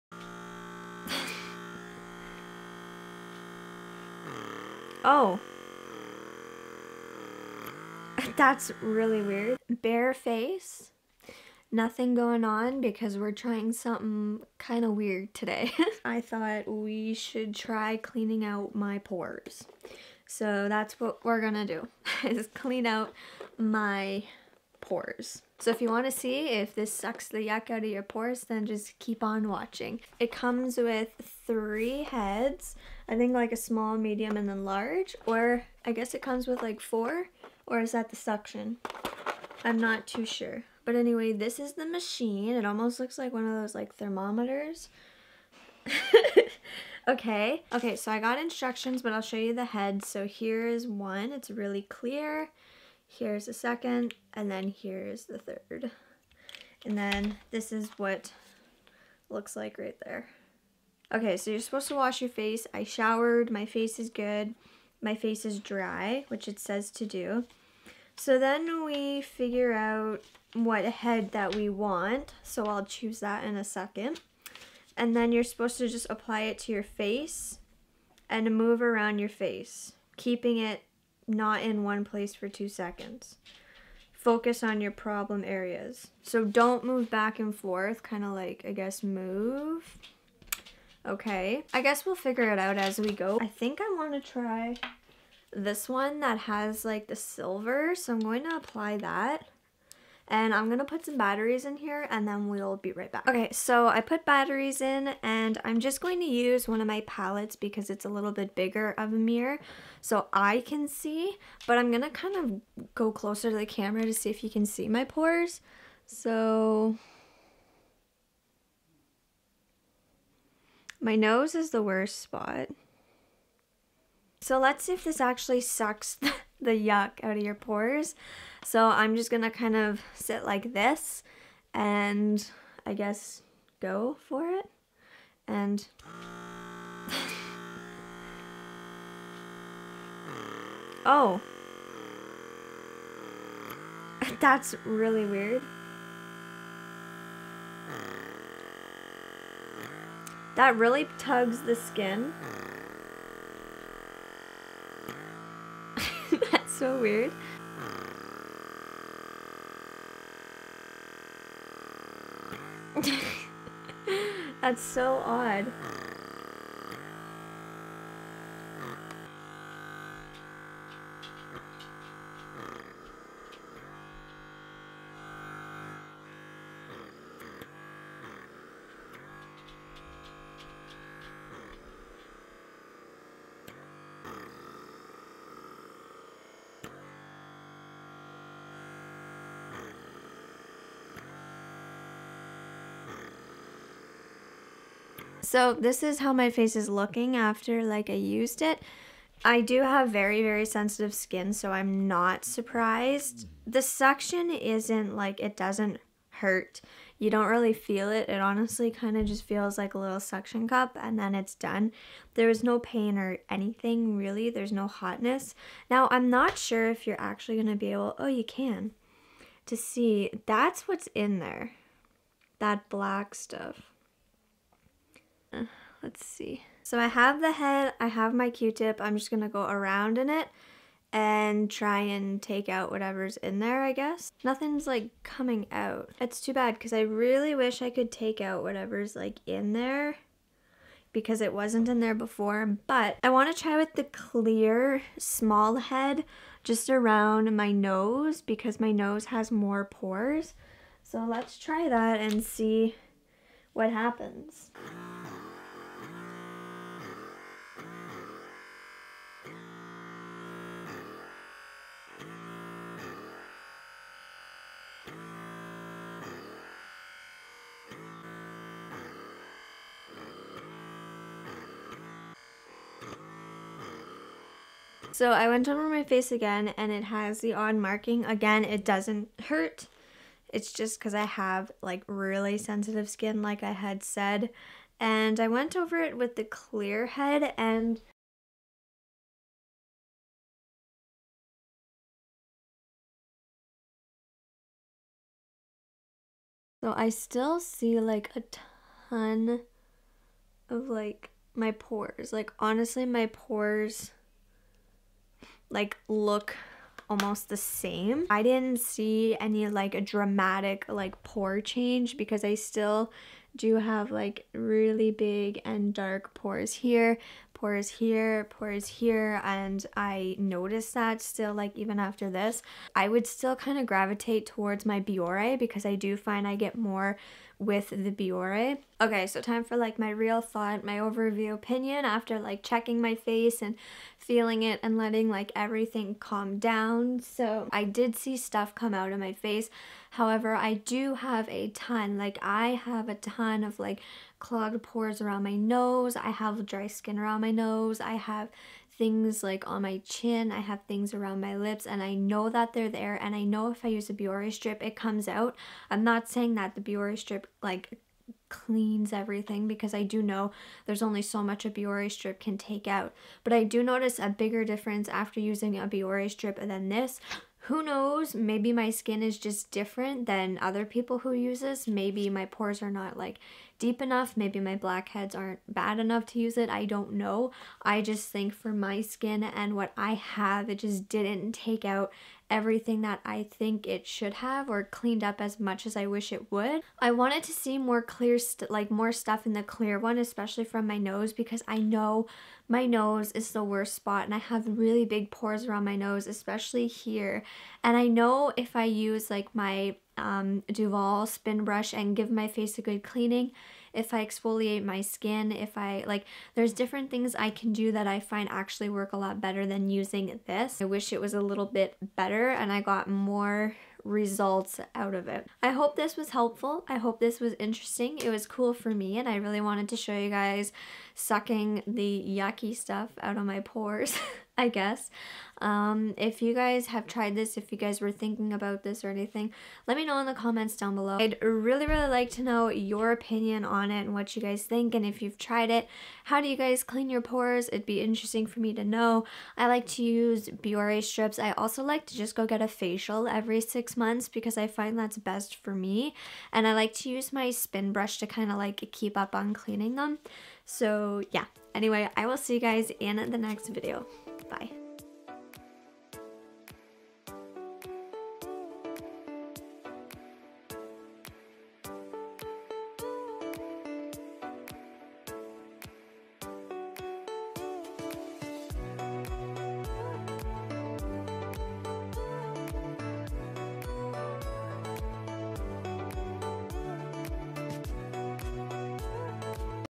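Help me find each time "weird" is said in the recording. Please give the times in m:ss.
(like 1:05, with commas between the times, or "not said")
0:09, 0:14, 2:25, 2:36.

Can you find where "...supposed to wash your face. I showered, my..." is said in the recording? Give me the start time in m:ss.
1:01.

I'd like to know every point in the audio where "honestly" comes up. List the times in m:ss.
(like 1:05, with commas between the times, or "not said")
3:28, 5:02.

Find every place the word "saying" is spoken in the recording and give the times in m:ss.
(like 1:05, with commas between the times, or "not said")
5:56.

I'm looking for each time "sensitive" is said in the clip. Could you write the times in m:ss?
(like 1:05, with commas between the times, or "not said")
3:20, 4:42.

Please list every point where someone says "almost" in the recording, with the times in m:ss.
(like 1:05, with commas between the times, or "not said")
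0:42, 5:07.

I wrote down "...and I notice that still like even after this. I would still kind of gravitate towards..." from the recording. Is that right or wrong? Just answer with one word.
right.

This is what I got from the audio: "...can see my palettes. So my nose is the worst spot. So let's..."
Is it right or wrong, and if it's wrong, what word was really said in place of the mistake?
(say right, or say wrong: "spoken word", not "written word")
wrong: "pores", not "palettes".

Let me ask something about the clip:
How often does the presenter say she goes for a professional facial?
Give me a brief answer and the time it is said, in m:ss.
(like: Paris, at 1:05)
Every 6 months, at 7:23.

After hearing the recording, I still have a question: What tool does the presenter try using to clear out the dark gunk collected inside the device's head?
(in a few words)
Q-tip.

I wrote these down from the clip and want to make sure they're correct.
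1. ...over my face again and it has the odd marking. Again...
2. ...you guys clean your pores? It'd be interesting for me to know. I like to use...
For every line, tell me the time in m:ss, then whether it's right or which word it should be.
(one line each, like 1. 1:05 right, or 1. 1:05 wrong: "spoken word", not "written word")
1. 4:35 right
2. 7:16 right.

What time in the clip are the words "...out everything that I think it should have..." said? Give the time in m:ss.
6:21.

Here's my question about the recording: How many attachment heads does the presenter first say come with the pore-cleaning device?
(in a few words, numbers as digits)
3.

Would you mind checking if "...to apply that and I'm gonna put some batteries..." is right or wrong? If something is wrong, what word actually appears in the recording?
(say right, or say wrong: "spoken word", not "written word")
right.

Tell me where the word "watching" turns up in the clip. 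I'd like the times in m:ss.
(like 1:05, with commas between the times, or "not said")
0:29.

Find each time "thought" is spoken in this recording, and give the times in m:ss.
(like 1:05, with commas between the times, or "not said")
0:16, 5:30.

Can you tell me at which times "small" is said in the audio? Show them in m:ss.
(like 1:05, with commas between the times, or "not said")
0:33, 4:05.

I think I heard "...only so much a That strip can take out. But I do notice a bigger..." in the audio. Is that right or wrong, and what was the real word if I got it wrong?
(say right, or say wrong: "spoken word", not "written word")
wrong: "Biore", not "That".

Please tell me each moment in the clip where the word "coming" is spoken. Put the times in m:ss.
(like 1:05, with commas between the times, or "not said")
3:55.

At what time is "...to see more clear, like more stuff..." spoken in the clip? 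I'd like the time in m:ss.
6:27.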